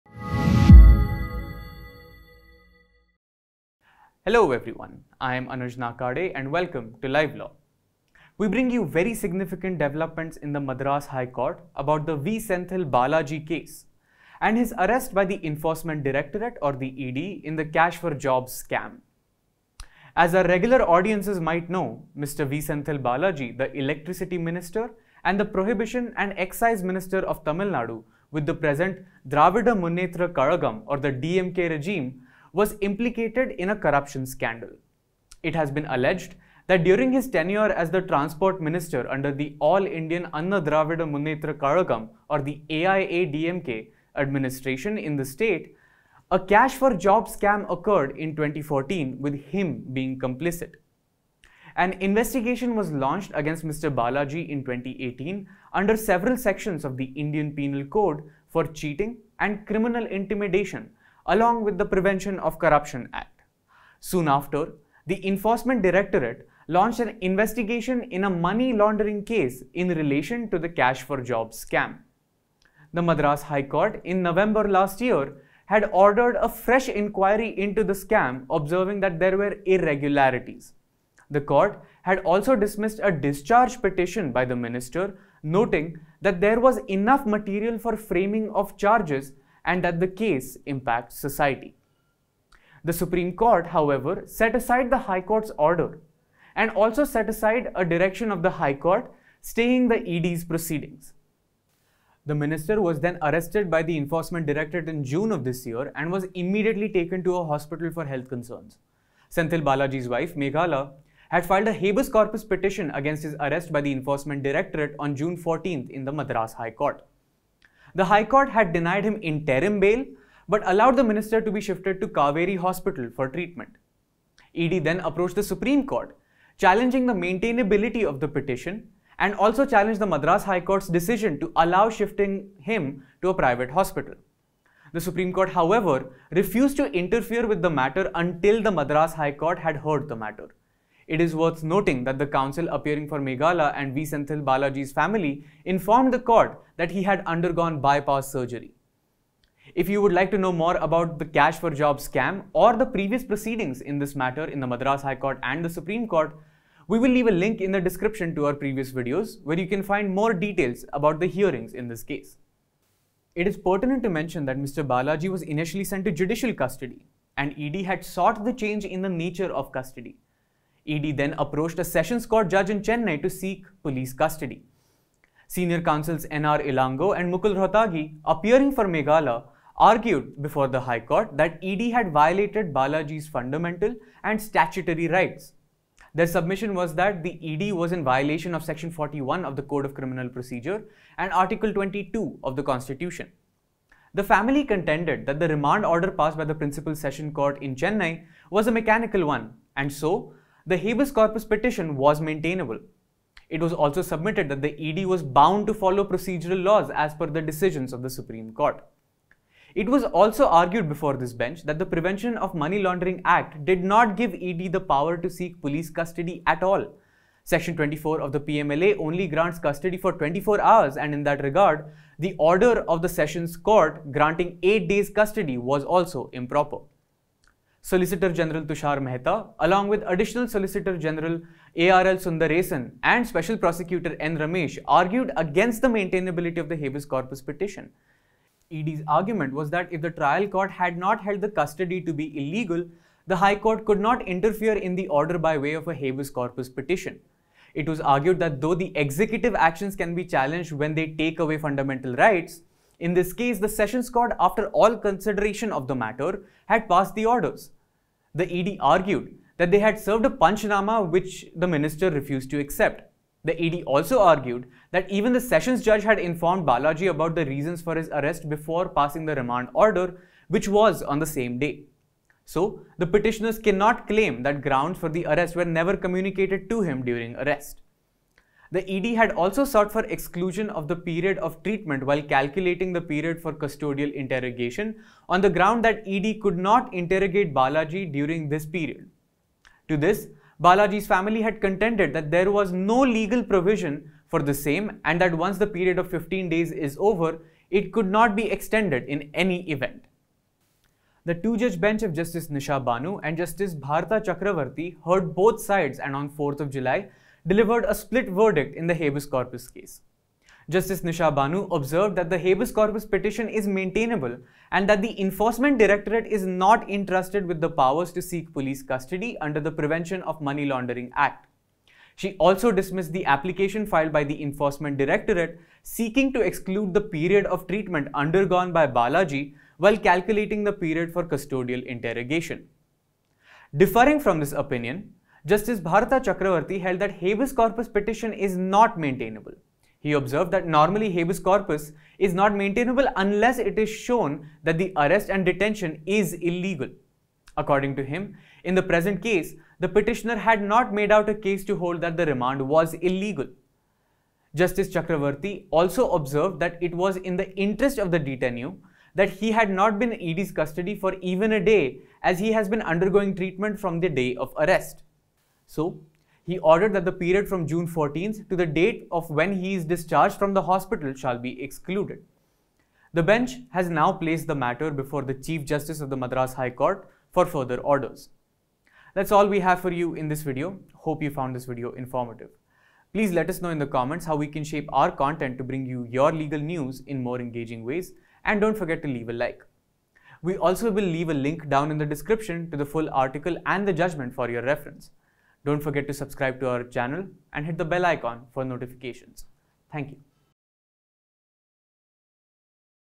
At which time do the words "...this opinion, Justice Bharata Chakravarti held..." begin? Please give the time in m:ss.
5:34.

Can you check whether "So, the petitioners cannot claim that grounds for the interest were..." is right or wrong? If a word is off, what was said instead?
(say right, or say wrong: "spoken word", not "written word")
wrong: "arrest", not "interest".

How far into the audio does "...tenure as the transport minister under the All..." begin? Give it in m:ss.
0:37.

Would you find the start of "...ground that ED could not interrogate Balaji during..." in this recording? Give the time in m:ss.
4:45.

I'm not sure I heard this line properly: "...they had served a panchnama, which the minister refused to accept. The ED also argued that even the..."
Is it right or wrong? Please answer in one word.
right.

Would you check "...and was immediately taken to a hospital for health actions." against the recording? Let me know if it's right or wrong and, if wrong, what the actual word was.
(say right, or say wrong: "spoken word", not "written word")
wrong: "concerns", not "actions".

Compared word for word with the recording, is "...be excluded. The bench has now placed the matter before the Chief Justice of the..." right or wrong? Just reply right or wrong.
right.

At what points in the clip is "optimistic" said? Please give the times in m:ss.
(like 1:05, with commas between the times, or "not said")
not said.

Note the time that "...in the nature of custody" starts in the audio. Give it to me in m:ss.
2:48.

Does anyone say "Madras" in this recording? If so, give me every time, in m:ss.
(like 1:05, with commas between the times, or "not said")
0:10, 1:13, 1:56, 2:10, 2:18, 2:34, 6:16.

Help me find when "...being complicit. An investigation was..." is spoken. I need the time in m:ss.
0:49.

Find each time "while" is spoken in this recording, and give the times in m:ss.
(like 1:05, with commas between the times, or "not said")
4:42, 5:29.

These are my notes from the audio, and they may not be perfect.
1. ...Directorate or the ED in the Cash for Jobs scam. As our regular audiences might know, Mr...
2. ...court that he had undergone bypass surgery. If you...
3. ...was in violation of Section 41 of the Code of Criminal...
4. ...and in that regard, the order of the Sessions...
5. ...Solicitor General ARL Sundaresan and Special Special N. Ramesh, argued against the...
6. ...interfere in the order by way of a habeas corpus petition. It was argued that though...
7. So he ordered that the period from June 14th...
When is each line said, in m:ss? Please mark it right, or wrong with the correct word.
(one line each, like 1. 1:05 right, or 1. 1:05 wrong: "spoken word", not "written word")
1. 0:16 right
2. 2:26 right
3. 3:07 right
4. 3:40 right
5. 3:50 wrong: "Prosecutor", not "Special"
6. 4:04 right
7. 6:05 right.